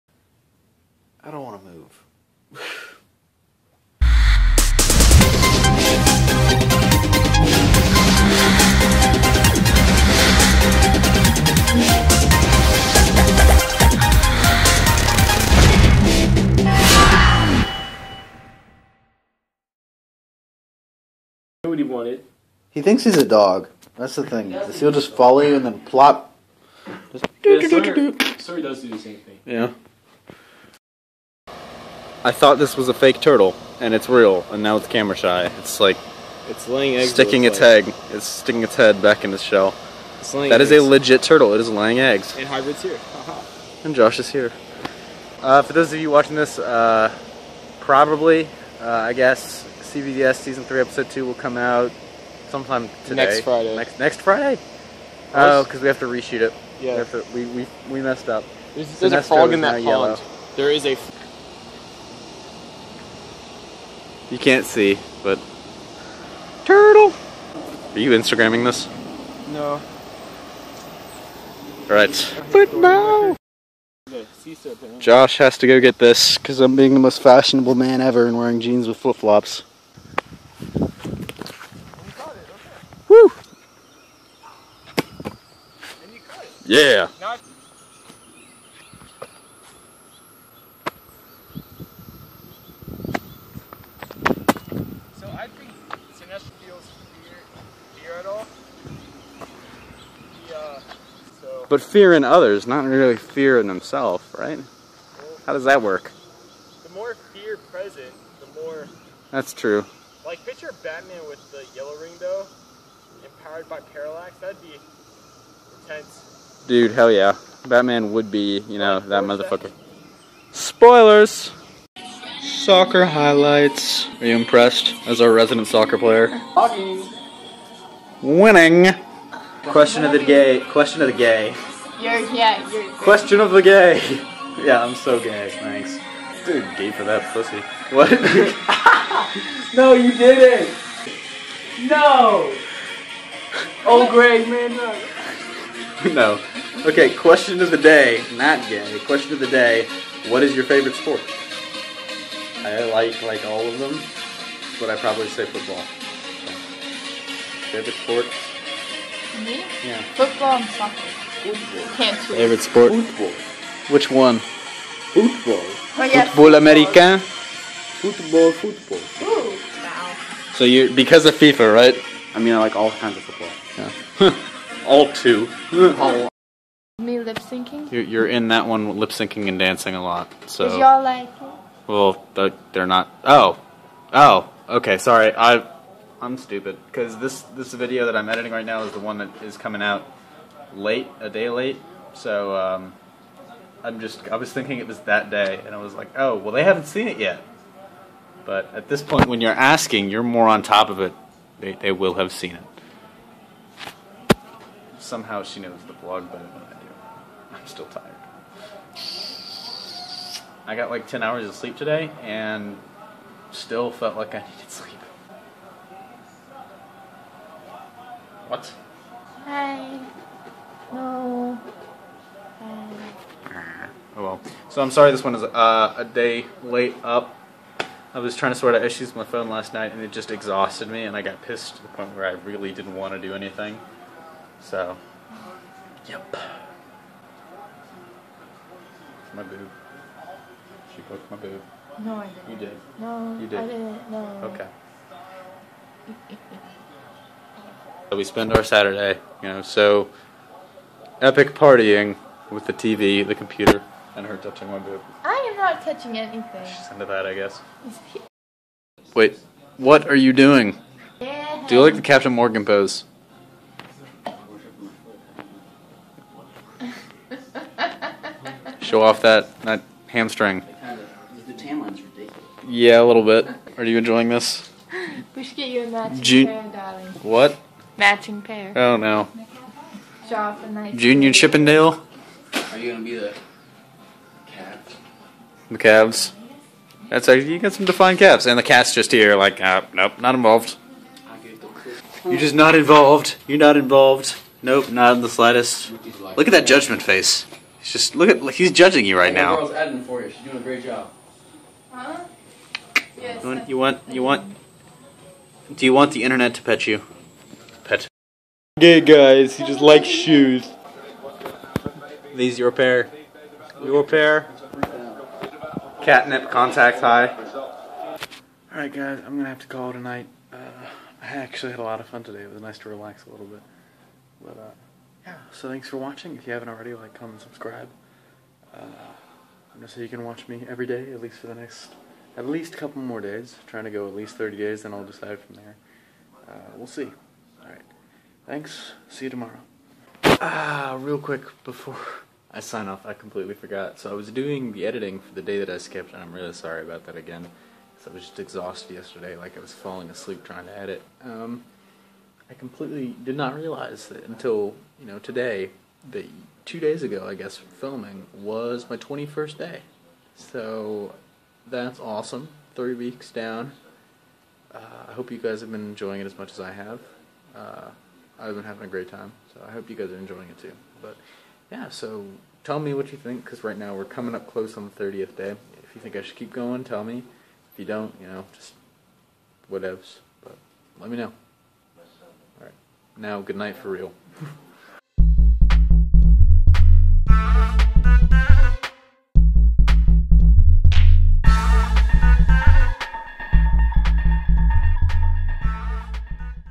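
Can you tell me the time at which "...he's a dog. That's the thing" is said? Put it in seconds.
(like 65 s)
23 s.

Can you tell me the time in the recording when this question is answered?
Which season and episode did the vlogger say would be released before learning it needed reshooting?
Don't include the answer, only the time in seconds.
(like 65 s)
50 s.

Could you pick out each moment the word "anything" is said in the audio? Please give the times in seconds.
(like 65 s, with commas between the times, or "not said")
233 s, 256 s.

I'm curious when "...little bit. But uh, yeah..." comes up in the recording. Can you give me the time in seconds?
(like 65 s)
323 s.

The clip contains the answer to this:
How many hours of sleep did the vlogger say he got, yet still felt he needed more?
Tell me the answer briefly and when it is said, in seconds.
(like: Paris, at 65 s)
10, at 211 s.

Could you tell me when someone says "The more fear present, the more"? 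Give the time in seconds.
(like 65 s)
106 s.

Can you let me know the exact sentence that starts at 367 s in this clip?
Uh, I've been having a great time, so I hope you guys are enjoying it too.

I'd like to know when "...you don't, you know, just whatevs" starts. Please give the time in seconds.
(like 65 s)
377 s.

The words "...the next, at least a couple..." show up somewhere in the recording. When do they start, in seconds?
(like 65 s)
331 s.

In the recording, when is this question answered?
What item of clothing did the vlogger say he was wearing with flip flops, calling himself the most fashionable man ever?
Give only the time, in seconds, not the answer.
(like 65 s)
78 s.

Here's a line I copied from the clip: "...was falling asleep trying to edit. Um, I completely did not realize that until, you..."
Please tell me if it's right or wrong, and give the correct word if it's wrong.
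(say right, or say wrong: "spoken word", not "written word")
right.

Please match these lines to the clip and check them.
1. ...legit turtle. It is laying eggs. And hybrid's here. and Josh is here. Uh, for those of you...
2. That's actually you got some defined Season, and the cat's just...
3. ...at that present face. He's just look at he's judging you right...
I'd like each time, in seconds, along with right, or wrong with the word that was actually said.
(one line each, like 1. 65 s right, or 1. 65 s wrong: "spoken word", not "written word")
1. 40 s right
2. 287 s wrong: "Cavs", not "Season"
3. 296 s wrong: "judgment", not "present".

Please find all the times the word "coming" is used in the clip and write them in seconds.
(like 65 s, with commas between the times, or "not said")
189 s, 374 s.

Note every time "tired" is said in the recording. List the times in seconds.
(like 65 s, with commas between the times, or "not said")
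207 s.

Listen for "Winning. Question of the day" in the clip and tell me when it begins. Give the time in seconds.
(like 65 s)
128 s.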